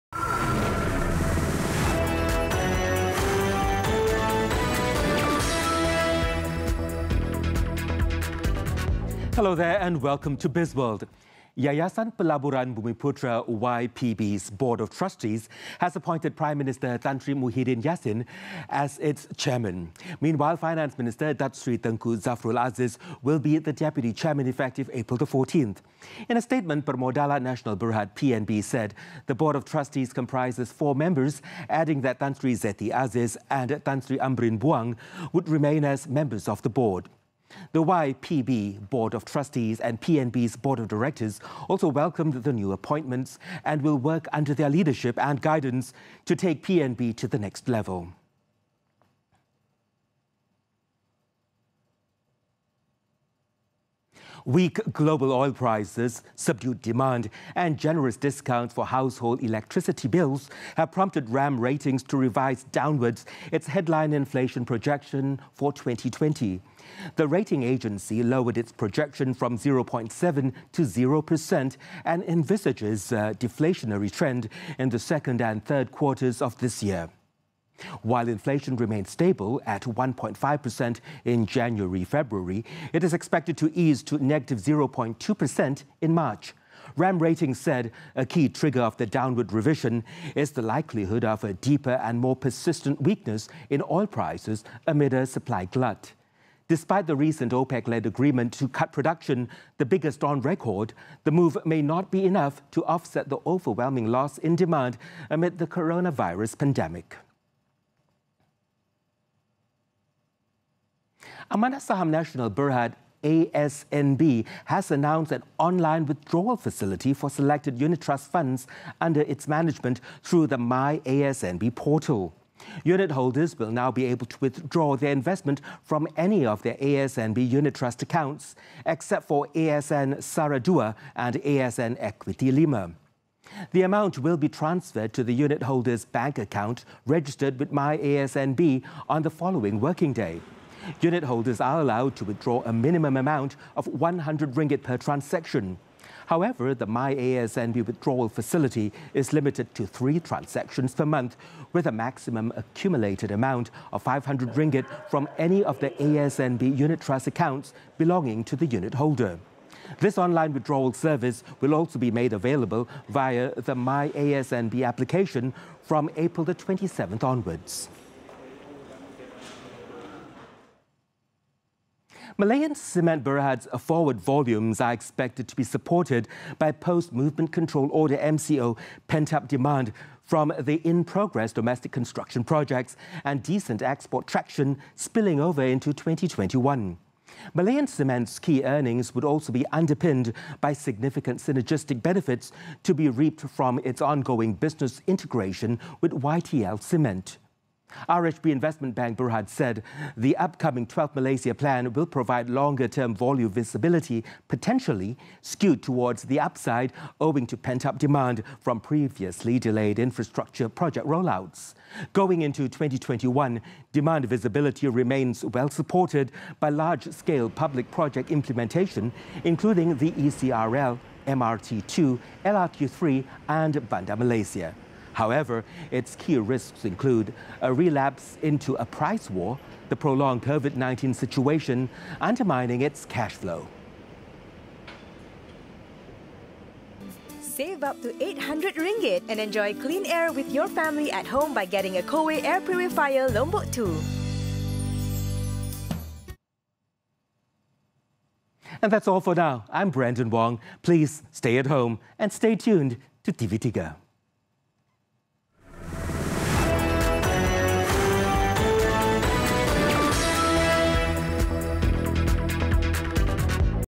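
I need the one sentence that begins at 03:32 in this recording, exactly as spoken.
Going into 2021, demand visibility remains well supported by large scale public project implementation, including the ECRL, MRT2, LRT3, and Bandar Malaysia.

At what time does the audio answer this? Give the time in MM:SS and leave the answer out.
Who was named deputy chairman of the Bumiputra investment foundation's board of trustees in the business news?
00:21.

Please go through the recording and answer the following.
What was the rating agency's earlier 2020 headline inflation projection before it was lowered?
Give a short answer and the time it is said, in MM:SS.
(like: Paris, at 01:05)
0.7%, at 01:09.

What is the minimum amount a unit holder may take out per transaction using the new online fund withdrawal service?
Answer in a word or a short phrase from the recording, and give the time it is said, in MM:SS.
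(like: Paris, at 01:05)
100 ringgit, at 02:23.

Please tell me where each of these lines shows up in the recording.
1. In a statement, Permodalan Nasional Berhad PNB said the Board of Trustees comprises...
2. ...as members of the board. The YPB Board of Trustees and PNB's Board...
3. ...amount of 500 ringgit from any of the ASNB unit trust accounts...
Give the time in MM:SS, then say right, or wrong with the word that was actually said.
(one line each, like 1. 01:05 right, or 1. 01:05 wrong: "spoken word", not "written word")
1. 00:26 right
2. 00:35 right
3. 02:33 right.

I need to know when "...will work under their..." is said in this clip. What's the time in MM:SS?
00:43.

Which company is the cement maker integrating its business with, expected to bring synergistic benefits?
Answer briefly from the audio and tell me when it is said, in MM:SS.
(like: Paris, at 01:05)
YTL Cement, at 03:16.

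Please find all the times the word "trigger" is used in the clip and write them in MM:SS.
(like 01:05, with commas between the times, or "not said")
01:28.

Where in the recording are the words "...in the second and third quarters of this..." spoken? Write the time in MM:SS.
01:14.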